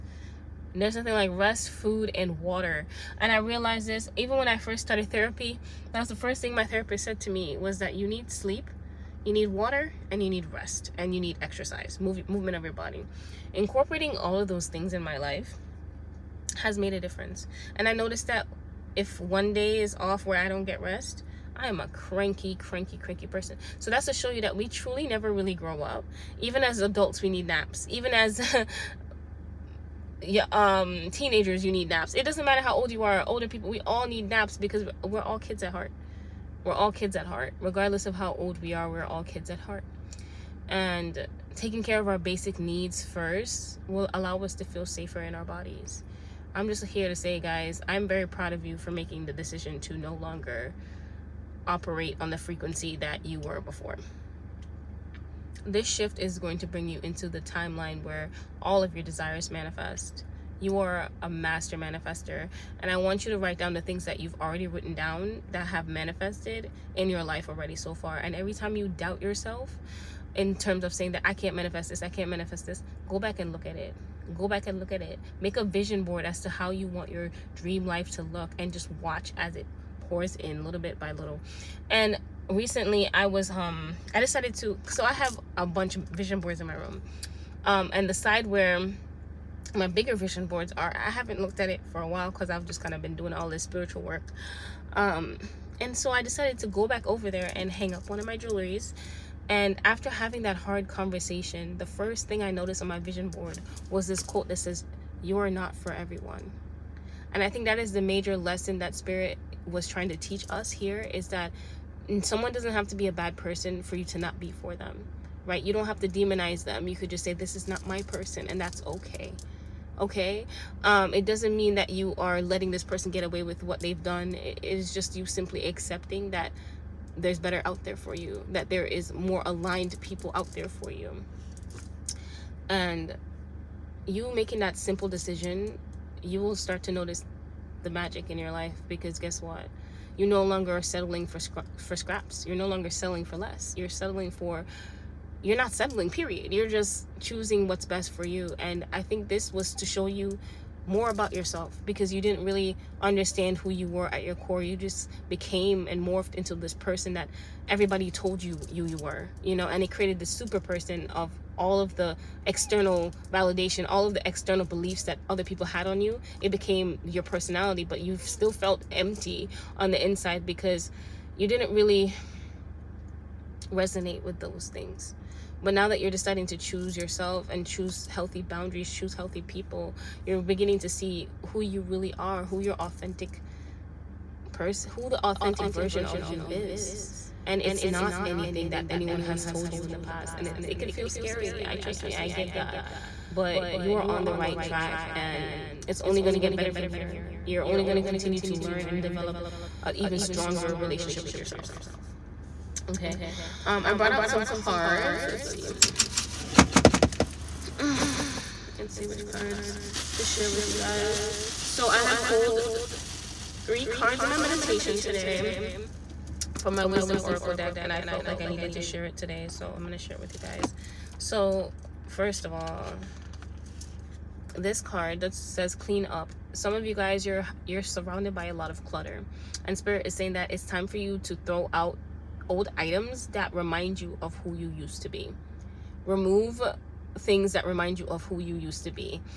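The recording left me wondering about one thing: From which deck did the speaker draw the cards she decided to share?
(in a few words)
Wisdom oracle deck.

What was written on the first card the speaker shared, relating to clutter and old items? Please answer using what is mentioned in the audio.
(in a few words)
Clean up.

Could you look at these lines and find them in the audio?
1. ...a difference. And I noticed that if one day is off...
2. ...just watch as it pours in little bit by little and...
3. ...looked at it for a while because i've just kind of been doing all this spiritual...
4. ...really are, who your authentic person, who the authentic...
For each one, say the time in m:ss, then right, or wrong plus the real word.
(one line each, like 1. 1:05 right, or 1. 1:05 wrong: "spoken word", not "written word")
1. 0:16 right
2. 1:18 right
3. 1:31 right
4. 3:01 right.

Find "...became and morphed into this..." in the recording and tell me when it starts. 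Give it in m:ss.
2:35.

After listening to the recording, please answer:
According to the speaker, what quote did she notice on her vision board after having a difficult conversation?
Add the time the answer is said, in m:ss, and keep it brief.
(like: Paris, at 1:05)
You are not for everyone, at 1:45.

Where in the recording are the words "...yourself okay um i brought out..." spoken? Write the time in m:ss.
3:21.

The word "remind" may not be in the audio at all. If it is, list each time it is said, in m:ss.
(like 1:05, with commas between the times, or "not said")
3:53, 3:57.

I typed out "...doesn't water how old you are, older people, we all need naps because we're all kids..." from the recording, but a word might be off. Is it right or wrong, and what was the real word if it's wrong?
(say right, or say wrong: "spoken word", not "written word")
wrong: "matter", not "water".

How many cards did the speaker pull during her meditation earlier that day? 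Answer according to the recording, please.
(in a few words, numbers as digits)
3.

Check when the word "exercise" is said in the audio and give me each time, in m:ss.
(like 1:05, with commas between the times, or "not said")
0:11.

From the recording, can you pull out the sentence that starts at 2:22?
You're no longer settling for less.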